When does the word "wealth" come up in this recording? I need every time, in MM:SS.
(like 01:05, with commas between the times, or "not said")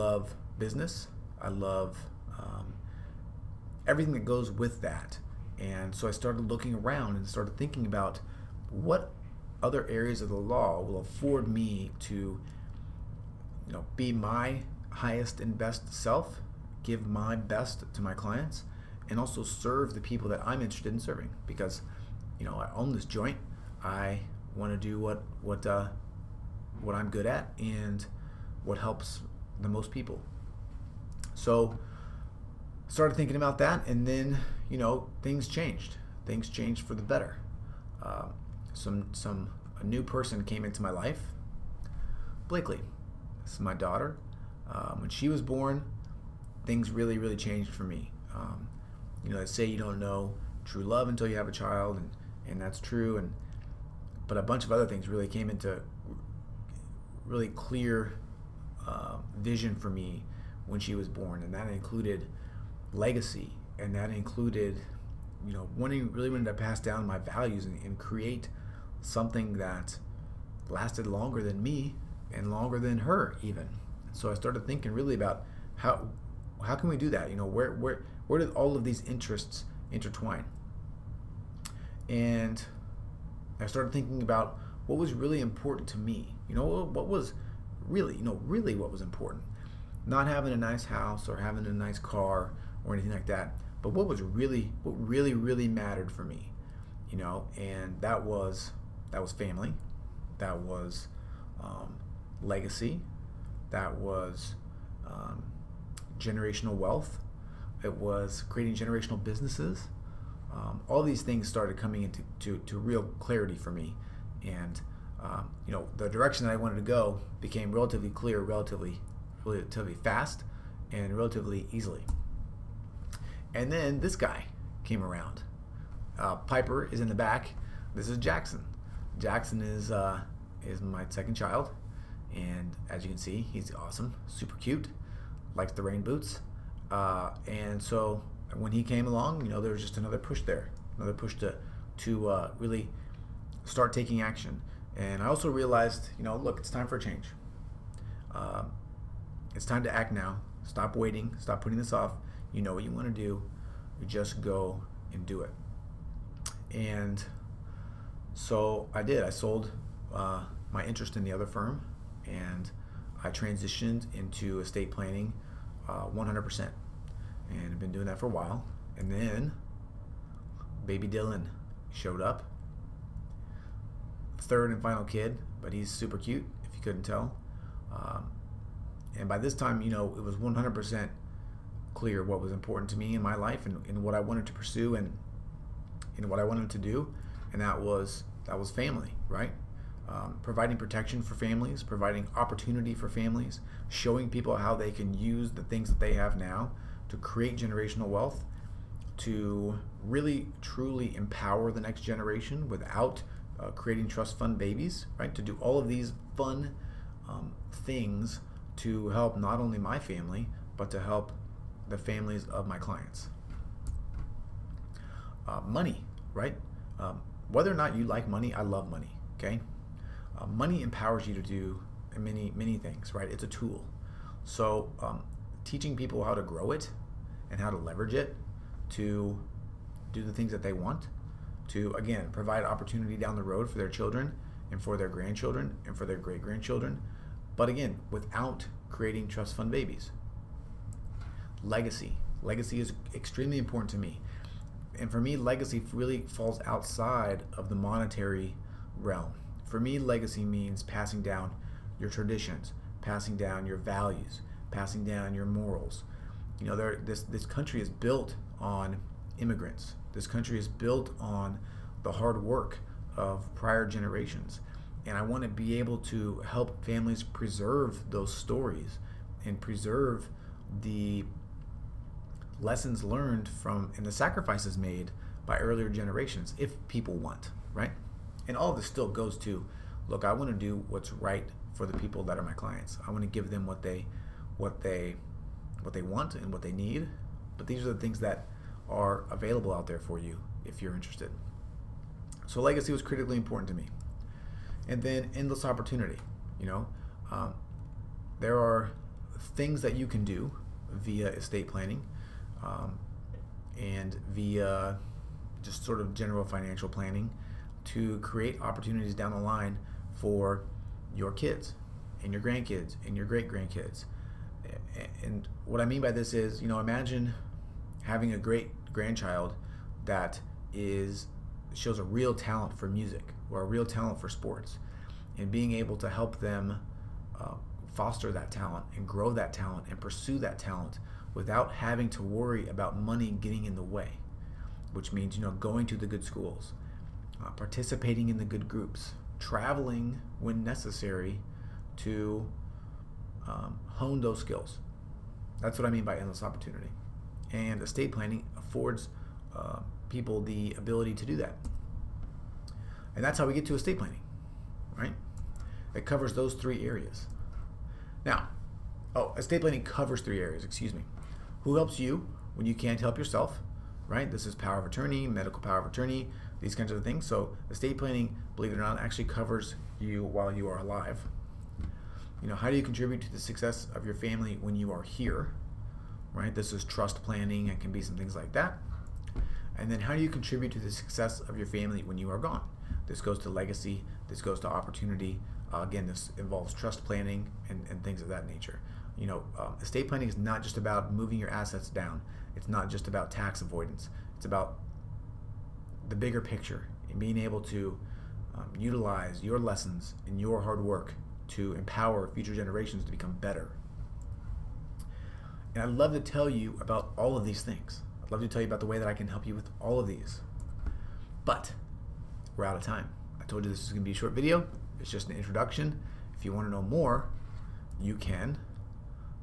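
01:46, 03:18.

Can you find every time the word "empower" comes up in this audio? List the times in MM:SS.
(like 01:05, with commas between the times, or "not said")
03:21, 03:40, 06:41.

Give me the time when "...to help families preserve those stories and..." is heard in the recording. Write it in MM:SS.
04:25.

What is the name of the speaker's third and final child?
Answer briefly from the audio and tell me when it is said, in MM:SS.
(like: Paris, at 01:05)
Dylan, at 02:51.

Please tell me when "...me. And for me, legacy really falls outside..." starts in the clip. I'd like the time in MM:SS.
04:03.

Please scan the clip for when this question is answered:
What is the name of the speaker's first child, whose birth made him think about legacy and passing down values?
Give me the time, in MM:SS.
00:42.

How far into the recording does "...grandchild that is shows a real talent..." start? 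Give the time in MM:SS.
05:18.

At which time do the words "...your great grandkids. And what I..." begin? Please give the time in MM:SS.
05:13.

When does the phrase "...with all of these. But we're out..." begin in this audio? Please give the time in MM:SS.
06:49.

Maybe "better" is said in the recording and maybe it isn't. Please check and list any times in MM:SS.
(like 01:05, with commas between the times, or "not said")
00:37, 06:43.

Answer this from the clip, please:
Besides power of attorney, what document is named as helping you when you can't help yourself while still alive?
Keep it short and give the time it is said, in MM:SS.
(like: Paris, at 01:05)
Medical power of attorney, at 06:05.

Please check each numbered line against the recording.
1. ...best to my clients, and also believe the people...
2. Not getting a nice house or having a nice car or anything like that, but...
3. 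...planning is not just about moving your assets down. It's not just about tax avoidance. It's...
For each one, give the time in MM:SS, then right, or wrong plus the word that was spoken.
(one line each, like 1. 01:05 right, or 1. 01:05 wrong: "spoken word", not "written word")
1. 00:17 wrong: "serve", not "believe"
2. 01:30 wrong: "having", not "getting"
3. 06:30 right.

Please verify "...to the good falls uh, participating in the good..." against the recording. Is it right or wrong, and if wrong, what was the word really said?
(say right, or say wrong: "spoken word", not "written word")
wrong: "schools", not "falls".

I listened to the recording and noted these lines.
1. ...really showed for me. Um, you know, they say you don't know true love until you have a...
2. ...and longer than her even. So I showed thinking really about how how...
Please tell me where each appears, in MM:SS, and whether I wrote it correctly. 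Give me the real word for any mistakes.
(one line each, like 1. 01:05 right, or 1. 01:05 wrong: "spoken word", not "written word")
1. 00:47 wrong: "changed", not "showed"
2. 01:12 wrong: "started", not "showed".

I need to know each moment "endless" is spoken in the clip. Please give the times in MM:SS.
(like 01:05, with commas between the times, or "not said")
04:55, 05:46.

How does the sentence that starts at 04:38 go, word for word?
And all of this still goes to look, I want to do what's right for the people that are my clients.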